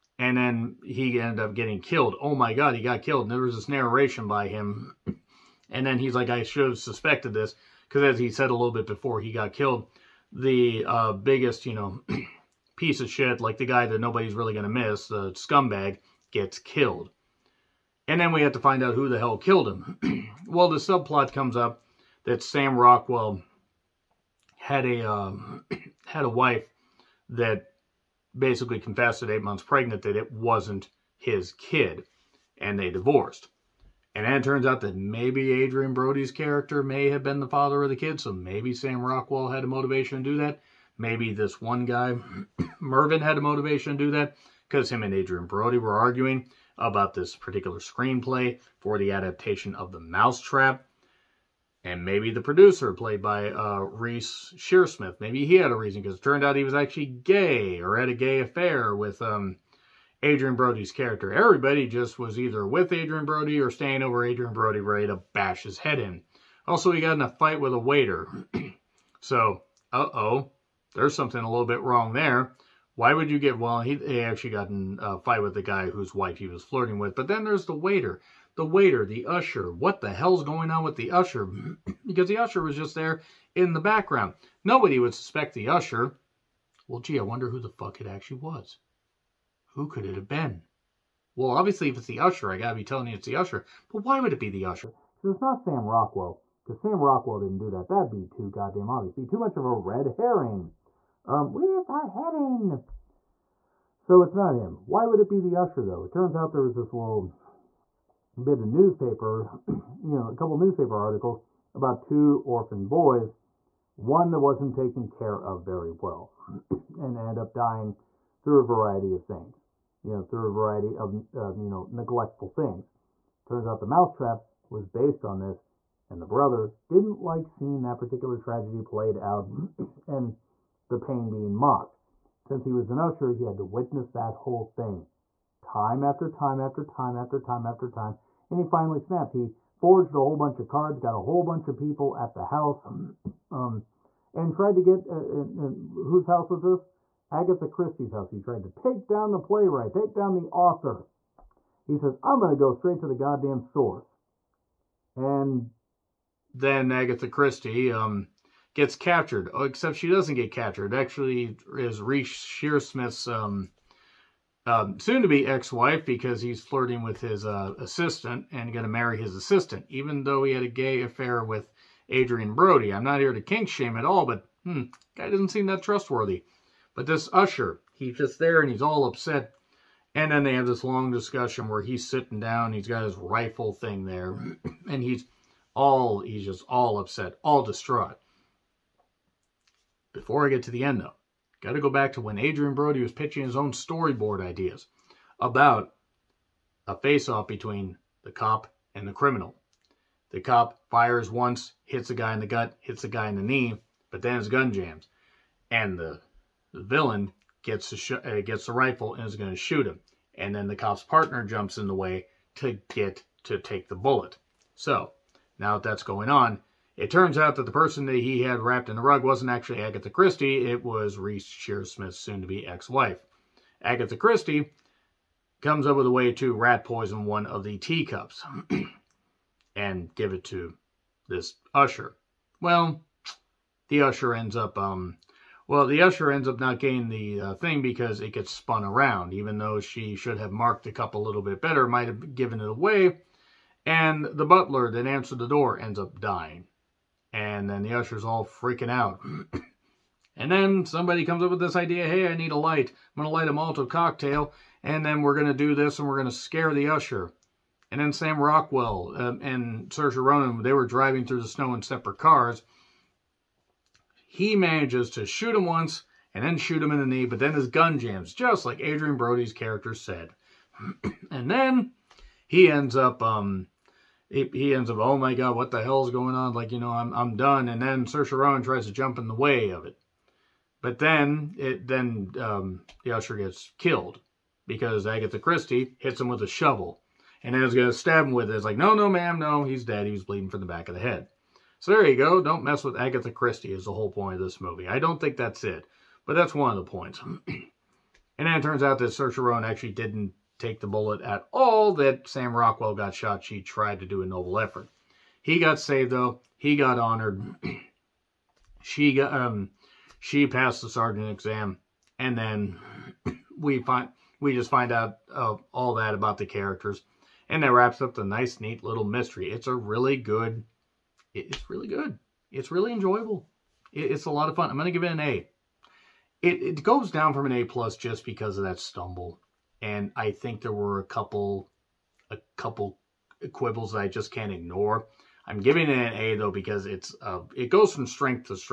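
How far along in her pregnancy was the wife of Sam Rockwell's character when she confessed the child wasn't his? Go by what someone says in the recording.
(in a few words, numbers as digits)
8 months.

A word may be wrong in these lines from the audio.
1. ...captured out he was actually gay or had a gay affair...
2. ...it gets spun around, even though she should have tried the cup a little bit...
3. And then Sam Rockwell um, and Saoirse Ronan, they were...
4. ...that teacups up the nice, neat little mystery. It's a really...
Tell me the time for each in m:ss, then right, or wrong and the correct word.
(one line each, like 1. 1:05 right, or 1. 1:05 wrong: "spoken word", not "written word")
1. 0:56 wrong: "turned", not "captured"
2. 3:58 wrong: "marked", not "tried"
3. 4:17 right
4. 5:17 wrong: "wraps", not "teacups".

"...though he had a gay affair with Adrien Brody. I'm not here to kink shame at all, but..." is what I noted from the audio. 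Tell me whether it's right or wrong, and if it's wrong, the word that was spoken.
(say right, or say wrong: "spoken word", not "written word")
right.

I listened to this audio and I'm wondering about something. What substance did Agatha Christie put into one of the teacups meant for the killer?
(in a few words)
Rat poison.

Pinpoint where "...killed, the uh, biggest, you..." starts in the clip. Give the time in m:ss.
0:09.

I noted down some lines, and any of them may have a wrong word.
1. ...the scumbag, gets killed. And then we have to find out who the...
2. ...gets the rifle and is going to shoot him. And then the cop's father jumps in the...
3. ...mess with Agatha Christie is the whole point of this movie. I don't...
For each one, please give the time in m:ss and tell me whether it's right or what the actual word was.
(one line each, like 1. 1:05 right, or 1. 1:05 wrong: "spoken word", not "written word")
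1. 0:15 right
2. 3:28 wrong: "partner", not "father"
3. 4:52 right.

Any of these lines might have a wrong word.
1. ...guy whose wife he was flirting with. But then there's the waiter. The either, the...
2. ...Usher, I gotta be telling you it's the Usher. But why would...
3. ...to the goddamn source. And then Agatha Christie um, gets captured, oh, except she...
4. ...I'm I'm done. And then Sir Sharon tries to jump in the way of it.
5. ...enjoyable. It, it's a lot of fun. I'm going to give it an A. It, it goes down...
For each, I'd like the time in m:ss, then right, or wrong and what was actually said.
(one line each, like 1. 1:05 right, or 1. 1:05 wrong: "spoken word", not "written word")
1. 1:15 wrong: "waiter", not "either"
2. 1:32 right
3. 2:32 right
4. 4:36 right
5. 5:22 right.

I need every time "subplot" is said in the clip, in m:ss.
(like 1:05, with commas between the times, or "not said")
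0:20.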